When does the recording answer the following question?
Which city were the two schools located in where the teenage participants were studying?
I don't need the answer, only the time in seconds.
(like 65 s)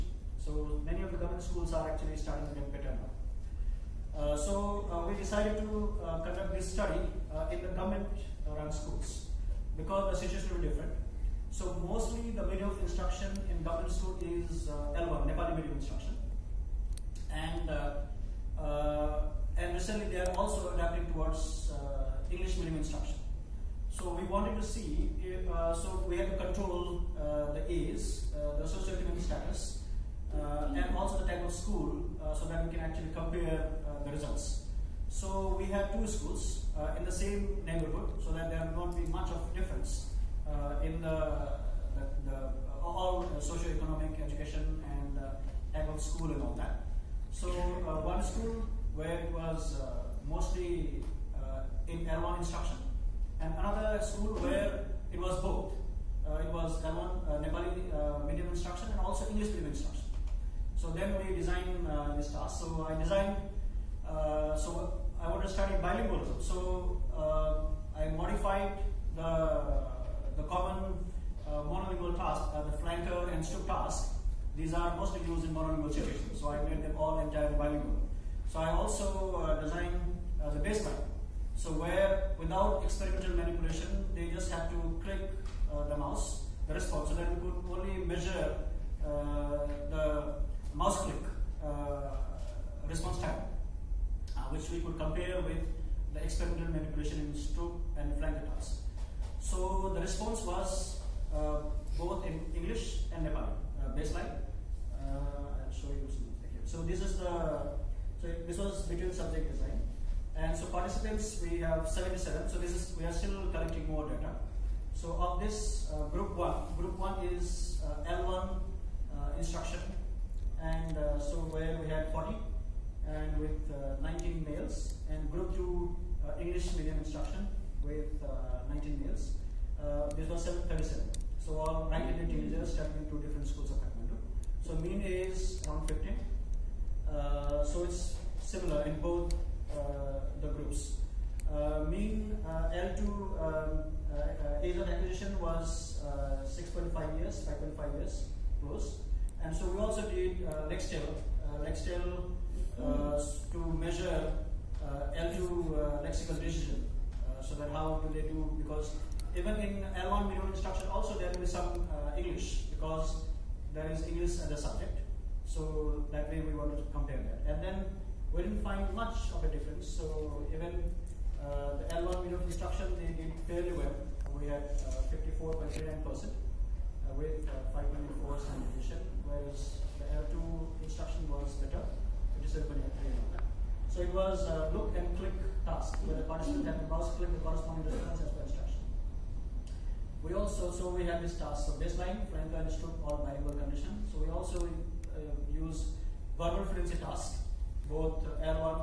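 133 s.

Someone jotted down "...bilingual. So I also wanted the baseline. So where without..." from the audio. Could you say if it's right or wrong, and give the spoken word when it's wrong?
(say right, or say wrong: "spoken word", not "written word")
wrong: "designed", not "wanted".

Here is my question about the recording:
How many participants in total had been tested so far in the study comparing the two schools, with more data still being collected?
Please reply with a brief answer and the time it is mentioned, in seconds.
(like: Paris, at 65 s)
77, at 111 s.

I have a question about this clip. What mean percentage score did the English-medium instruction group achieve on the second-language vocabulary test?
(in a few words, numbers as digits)
57.83%.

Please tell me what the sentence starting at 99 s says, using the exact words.
So the response was uh, both in English and Nepali baseline.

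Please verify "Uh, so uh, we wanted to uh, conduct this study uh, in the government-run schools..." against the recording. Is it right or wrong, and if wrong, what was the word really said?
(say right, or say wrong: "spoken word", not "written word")
wrong: "decided", not "wanted".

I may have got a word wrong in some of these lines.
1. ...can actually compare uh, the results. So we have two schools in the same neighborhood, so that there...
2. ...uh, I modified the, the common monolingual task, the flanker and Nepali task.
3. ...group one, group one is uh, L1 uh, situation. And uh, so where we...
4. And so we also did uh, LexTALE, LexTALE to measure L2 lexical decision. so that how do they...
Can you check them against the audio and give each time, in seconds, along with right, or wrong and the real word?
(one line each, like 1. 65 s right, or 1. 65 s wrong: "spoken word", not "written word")
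1. 32 s right
2. 67 s wrong: "Stroop", not "Nepali"
3. 116 s wrong: "instruction", not "situation"
4. 149 s right.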